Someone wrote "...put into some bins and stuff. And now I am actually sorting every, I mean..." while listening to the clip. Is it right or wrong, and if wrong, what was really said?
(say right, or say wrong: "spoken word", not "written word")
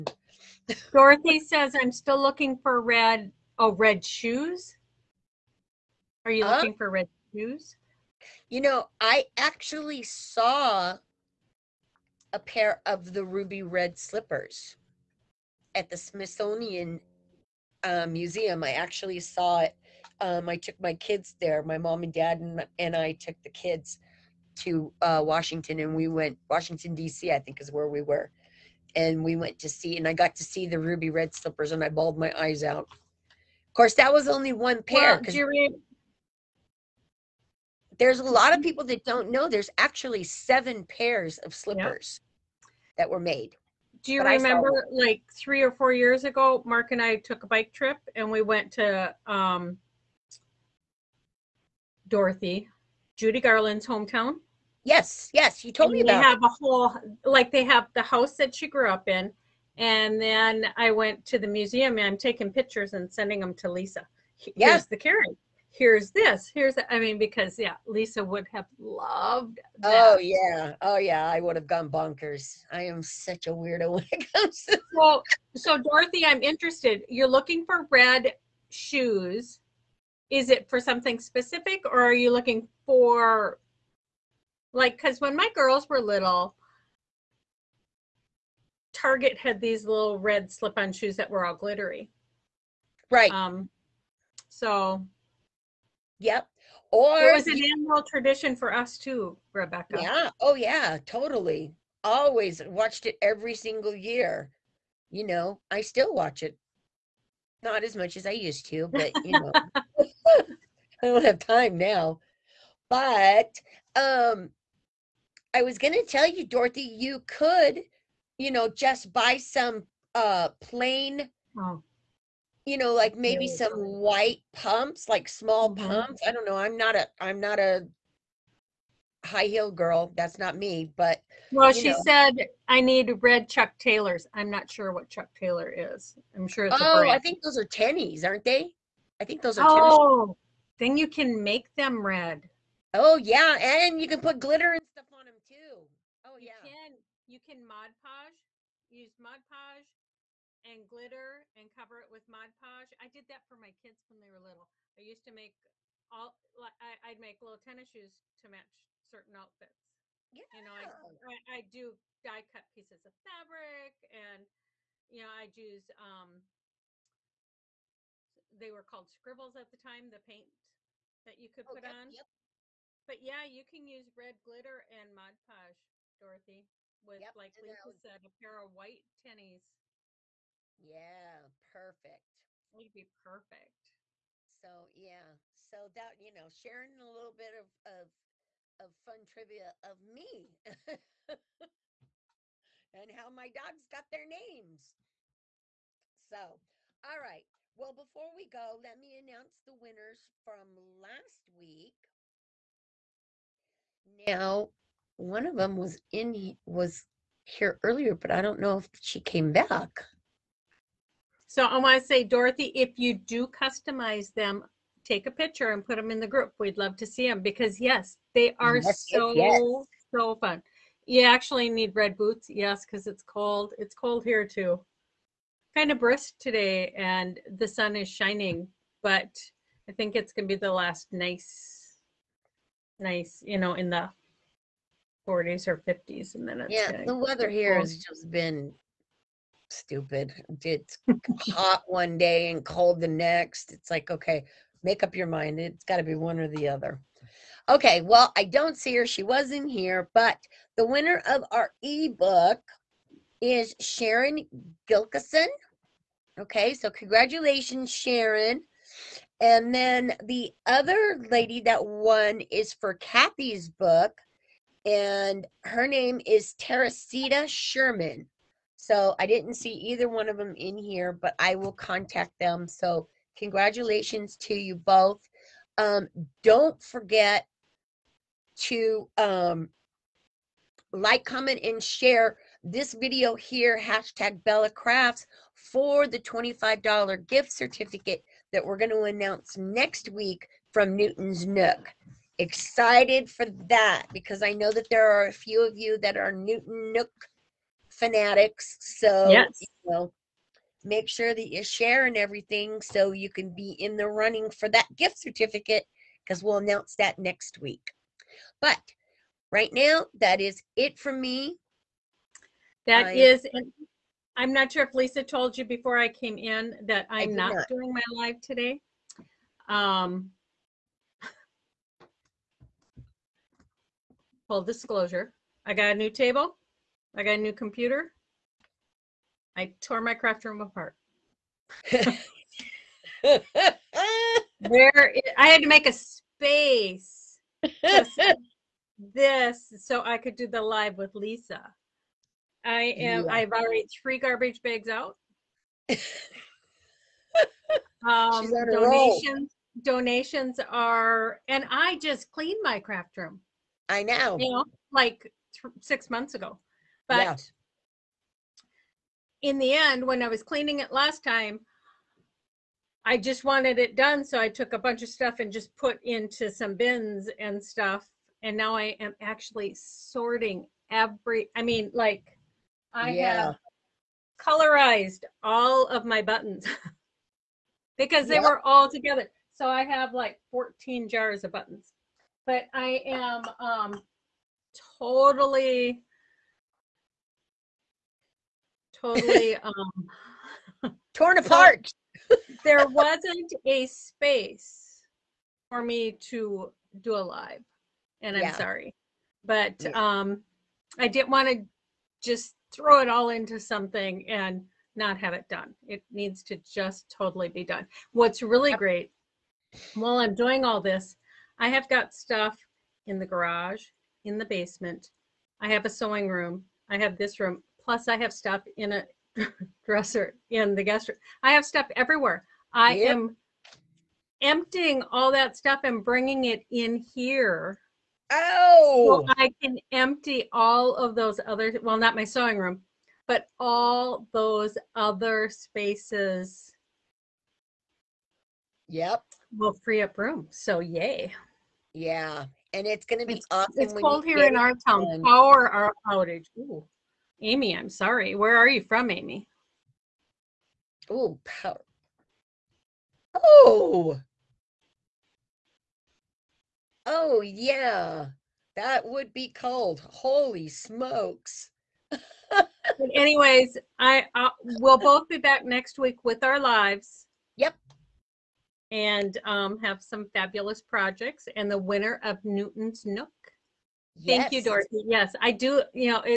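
right.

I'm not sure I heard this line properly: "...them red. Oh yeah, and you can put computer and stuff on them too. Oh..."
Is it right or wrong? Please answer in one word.
wrong.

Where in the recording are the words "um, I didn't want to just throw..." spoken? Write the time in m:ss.
6:39.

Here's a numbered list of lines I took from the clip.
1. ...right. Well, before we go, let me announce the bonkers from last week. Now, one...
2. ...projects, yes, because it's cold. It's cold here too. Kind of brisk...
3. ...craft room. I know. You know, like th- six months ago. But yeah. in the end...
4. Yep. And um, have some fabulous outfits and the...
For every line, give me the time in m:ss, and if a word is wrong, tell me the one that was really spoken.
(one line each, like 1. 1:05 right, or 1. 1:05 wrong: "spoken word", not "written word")
1. 3:17 wrong: "winners", not "bonkers"
2. 3:42 wrong: "boots", not "projects"
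3. 5:52 right
4. 7:47 wrong: "projects", not "outfits".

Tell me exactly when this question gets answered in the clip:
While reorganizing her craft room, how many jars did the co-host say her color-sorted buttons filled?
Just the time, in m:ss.
6:20.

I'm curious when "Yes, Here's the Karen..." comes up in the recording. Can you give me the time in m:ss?
1:04.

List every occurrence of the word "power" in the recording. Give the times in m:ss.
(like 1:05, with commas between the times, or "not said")
7:25, 7:31.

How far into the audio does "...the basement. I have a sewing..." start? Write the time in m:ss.
6:54.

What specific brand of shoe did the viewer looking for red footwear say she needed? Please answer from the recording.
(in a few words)
Chuck Taylors.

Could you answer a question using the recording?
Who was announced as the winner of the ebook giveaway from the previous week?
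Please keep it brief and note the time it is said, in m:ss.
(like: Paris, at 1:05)
Sharon Gilkison, at 4:13.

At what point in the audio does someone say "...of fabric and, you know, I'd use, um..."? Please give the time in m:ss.
2:43.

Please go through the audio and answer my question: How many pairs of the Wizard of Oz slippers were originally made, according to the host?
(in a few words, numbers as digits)
7.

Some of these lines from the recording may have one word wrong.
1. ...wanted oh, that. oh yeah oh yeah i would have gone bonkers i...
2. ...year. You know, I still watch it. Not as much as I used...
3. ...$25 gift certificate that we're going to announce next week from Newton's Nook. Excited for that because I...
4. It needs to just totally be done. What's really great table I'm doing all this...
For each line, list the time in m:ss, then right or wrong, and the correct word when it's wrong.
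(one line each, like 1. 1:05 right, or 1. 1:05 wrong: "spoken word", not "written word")
1. 1:08 wrong: "loved", not "wanted"
2. 1:43 right
3. 4:46 right
4. 6:45 wrong: "while", not "table".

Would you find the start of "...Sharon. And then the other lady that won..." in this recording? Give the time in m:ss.
4:17.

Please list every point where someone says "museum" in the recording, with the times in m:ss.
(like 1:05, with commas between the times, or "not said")
0:18, 1:01.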